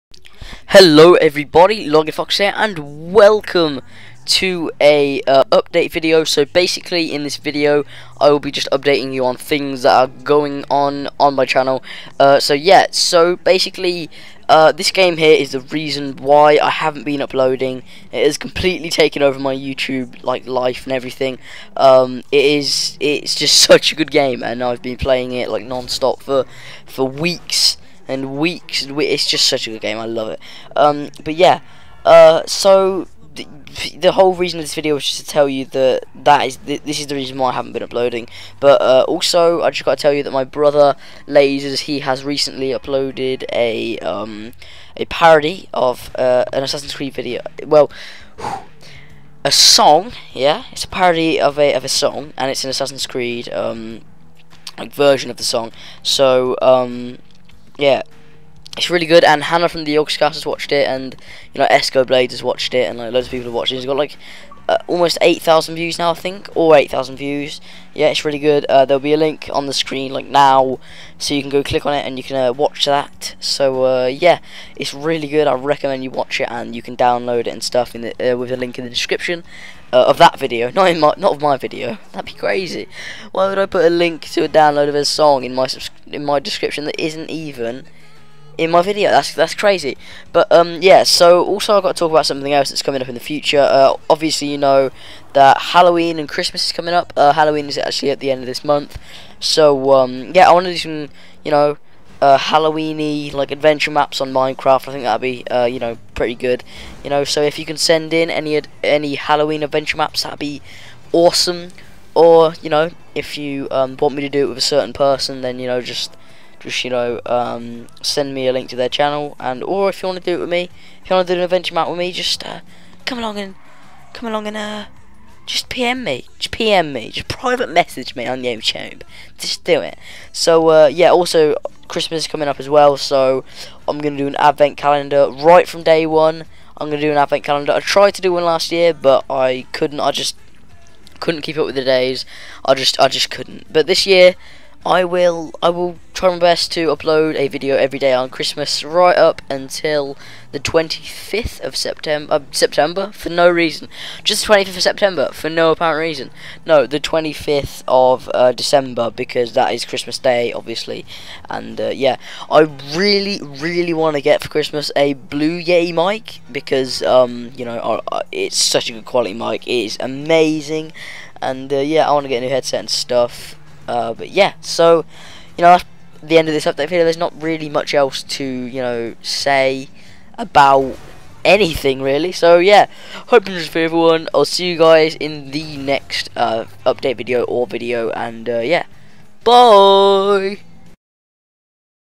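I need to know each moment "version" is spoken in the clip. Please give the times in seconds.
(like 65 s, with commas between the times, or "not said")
54 s.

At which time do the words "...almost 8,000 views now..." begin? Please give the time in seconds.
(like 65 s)
64 s.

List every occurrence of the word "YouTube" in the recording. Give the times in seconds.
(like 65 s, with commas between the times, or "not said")
19 s, 128 s.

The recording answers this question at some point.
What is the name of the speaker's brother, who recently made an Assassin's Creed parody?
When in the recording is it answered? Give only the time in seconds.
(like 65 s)
41 s.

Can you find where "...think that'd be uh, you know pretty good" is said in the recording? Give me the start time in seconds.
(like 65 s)
104 s.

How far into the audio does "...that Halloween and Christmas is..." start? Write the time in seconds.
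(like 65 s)
95 s.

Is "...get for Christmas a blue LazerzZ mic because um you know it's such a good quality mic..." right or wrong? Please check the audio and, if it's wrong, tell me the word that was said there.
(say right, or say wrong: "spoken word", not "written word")
wrong: "Yeti", not "LazerzZ".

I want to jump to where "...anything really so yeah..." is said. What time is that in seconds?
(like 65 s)
181 s.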